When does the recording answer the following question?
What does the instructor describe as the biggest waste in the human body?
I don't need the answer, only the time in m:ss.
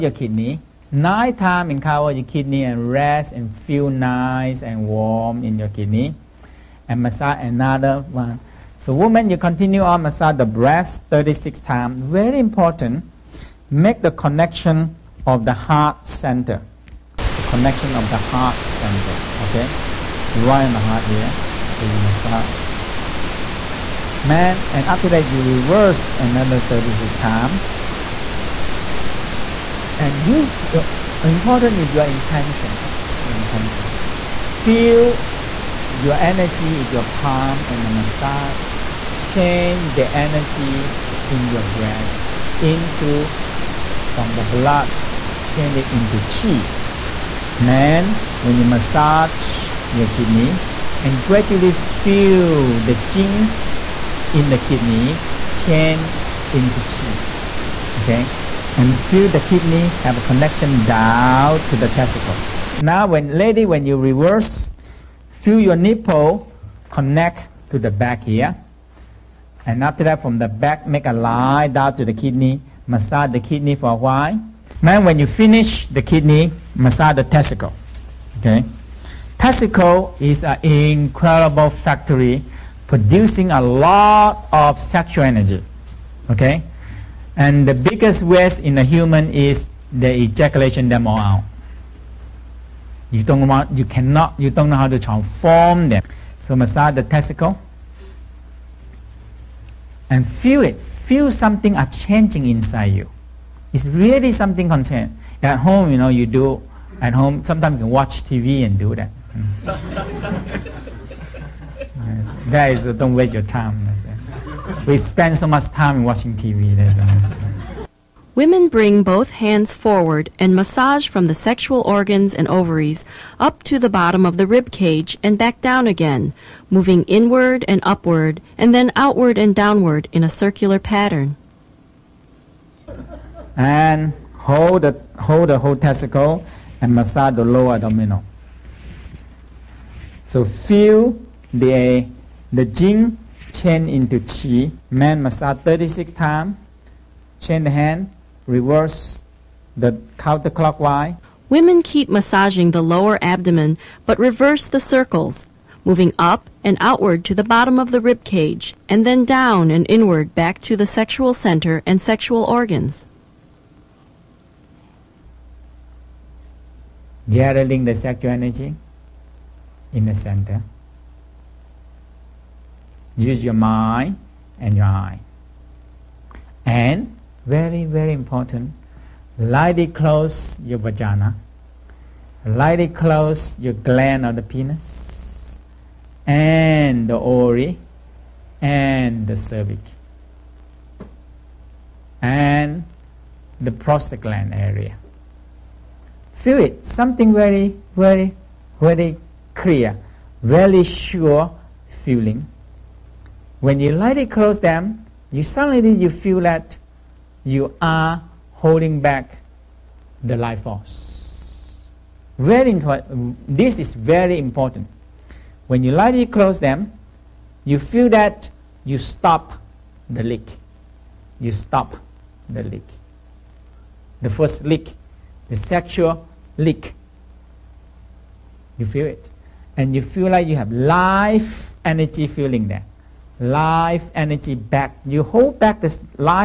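1:30.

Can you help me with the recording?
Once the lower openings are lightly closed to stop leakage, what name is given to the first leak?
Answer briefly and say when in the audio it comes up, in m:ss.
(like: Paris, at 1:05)
sexual leak, at 3:45.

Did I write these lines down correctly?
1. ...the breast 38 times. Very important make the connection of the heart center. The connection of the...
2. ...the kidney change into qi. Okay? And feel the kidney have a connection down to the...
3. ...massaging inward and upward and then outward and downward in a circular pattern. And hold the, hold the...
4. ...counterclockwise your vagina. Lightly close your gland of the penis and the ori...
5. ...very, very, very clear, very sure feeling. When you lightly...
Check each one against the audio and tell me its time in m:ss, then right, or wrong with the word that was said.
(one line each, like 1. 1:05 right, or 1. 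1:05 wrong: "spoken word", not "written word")
1. 0:10 wrong: "36", not "38"
2. 0:54 right
3. 2:06 wrong: "moving", not "massaging"
4. 2:59 wrong: "close", not "counterclockwise"
5. 3:17 right.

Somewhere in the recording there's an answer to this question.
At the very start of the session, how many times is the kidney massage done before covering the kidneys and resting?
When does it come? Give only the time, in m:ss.
0:00.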